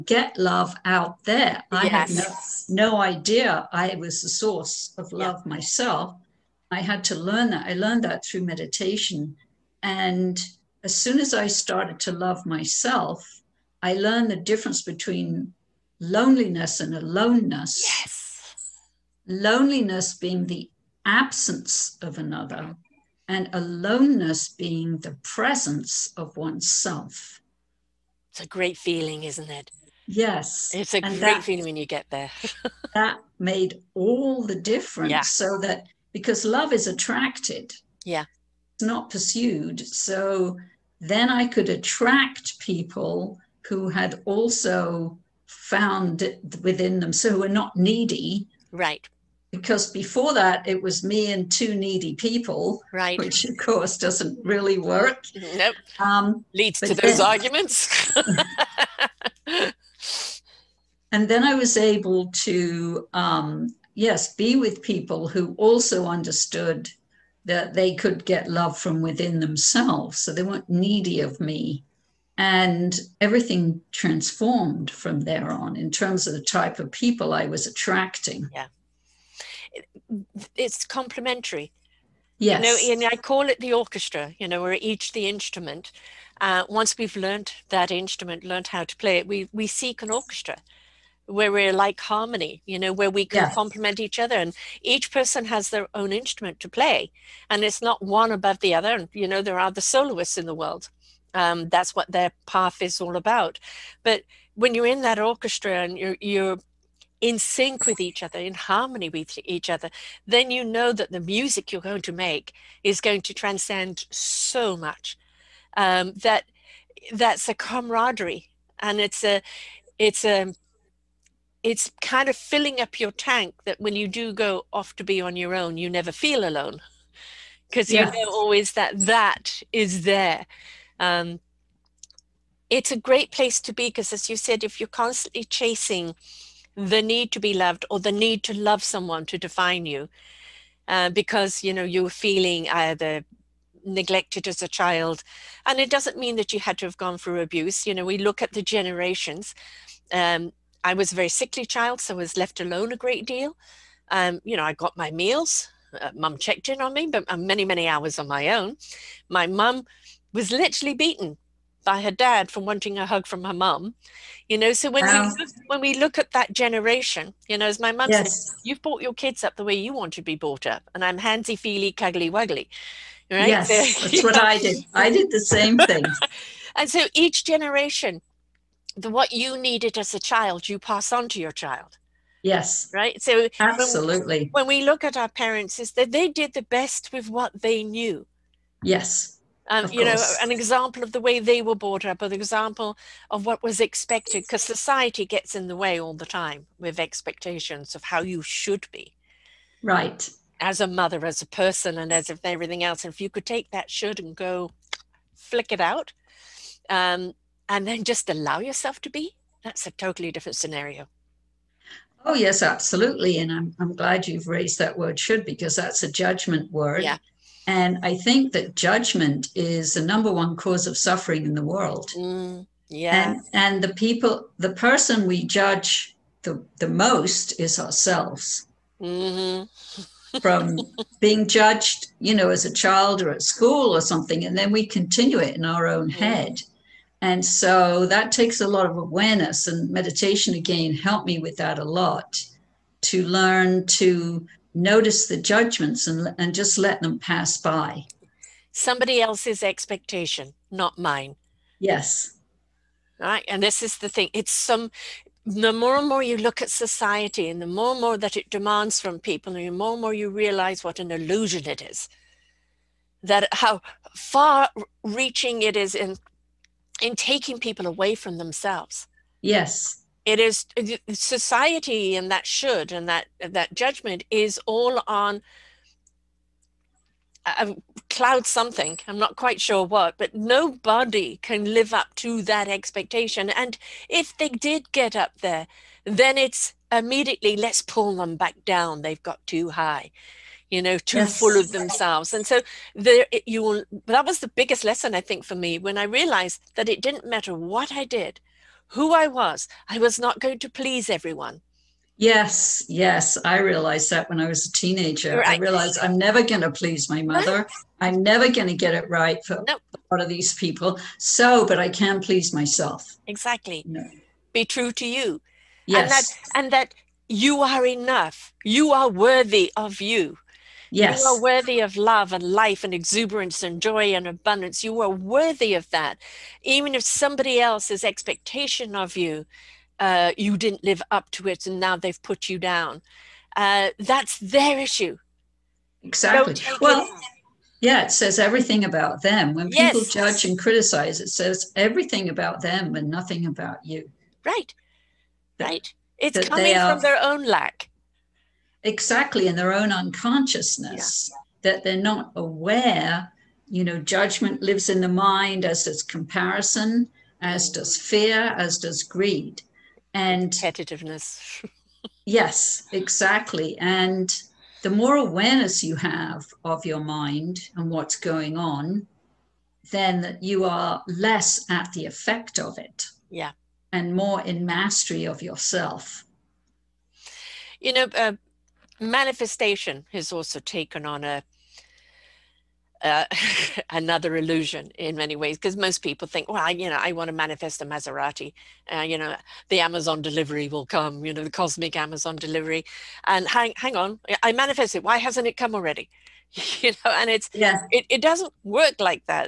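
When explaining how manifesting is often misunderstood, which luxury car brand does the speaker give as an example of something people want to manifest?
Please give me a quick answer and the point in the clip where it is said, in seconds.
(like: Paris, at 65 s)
Maserati, at 387 s.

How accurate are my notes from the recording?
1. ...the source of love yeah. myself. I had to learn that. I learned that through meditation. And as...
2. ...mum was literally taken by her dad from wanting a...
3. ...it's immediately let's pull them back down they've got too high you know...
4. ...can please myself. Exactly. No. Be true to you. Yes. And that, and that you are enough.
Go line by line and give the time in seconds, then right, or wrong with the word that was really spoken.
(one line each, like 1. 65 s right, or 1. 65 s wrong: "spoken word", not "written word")
1. 4 s right
2. 159 s wrong: "beaten", not "taken"
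3. 286 s right
4. 311 s right.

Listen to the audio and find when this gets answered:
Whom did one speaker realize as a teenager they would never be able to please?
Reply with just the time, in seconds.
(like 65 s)
307 s.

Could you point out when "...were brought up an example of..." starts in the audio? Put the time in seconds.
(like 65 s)
191 s.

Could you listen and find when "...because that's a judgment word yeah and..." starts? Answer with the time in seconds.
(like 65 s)
215 s.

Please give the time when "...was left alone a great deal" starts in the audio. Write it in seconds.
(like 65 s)
152 s.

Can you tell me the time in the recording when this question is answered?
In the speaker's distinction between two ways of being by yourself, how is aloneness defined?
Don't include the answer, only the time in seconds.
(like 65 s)
24 s.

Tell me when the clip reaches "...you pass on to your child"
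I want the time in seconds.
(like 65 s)
180 s.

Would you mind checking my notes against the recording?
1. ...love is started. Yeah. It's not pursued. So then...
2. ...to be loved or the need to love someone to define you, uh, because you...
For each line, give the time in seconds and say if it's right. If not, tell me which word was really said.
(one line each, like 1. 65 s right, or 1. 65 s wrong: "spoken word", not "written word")
1. 36 s wrong: "attracted", not "started"
2. 137 s right.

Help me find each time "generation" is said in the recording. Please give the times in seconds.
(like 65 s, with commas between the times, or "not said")
148 s, 166 s, 177 s.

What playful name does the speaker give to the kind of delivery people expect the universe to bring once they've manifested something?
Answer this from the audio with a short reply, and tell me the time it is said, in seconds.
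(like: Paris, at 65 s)
Cosmic Amazon delivery, at 391 s.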